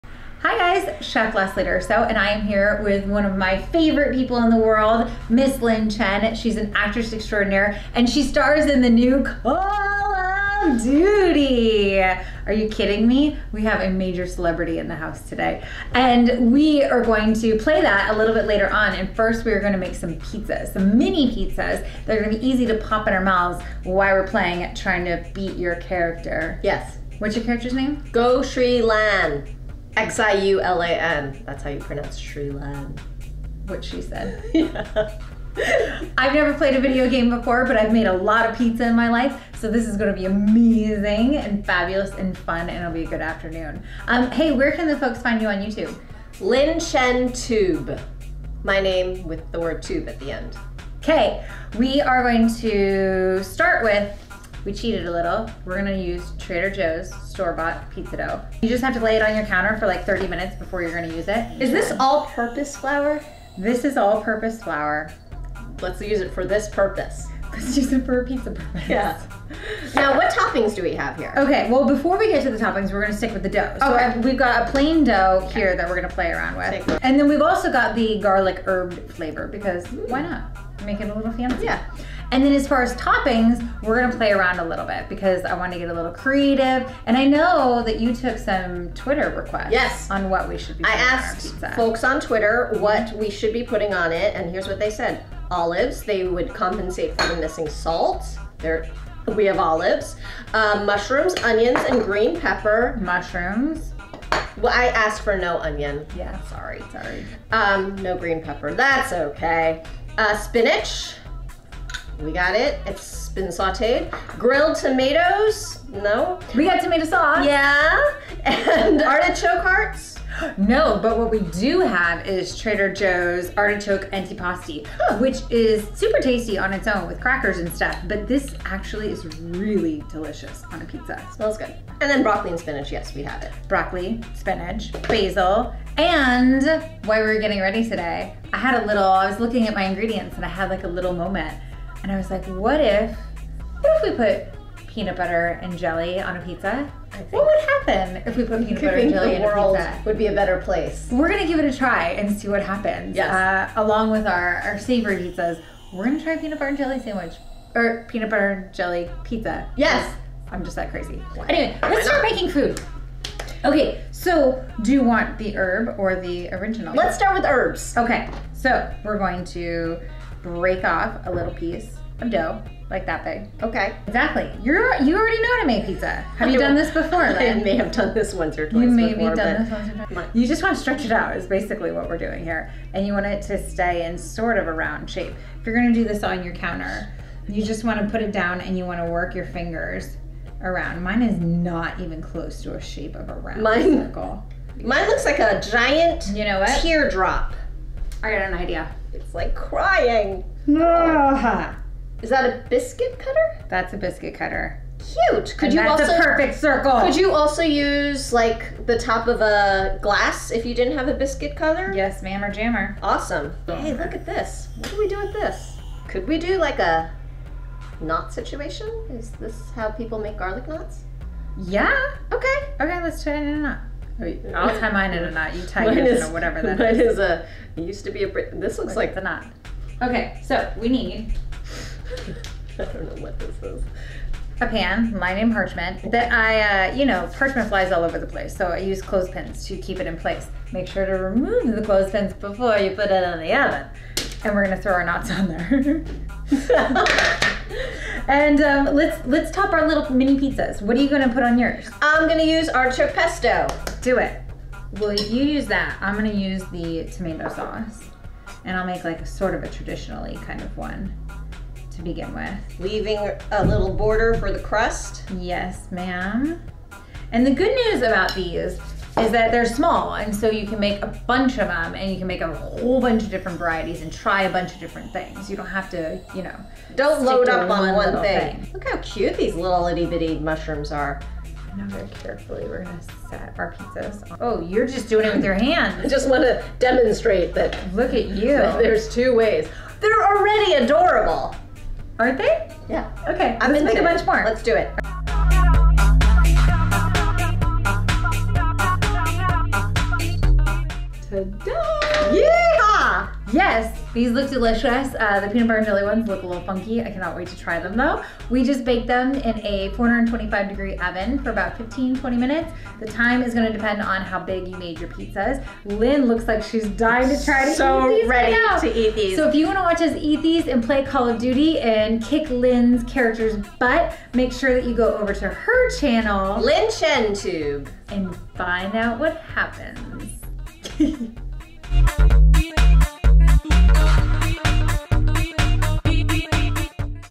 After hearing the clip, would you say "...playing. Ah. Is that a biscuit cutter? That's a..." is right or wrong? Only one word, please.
wrong.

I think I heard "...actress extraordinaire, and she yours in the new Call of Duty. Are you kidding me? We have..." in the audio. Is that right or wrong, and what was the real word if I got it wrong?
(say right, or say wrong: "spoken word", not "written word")
wrong: "stars", not "yours".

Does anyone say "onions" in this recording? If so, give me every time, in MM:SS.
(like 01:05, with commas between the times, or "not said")
01:41, 01:45.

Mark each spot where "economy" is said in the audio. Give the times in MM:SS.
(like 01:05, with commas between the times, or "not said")
not said.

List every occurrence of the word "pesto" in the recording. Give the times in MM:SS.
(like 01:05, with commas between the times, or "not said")
04:13.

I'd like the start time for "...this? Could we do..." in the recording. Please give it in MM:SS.
03:35.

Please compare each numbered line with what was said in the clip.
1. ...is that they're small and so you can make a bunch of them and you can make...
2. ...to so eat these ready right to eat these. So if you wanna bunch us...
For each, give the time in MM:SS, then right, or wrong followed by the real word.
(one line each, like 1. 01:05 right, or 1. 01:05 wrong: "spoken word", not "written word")
1. 04:29 right
2. 05:17 wrong: "watch", not "bunch".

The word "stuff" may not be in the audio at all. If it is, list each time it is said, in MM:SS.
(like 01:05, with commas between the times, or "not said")
02:07.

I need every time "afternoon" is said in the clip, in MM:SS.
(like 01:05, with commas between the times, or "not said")
00:43.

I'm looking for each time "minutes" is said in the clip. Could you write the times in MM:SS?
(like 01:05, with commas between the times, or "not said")
01:00, 05:12.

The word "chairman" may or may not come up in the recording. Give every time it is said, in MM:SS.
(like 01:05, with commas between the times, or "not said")
not said.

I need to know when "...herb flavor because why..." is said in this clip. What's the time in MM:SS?
01:18.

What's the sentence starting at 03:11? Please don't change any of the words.
Mine is not even close to a shape of a round Mine, circle.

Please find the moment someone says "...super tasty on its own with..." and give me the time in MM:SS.
02:05.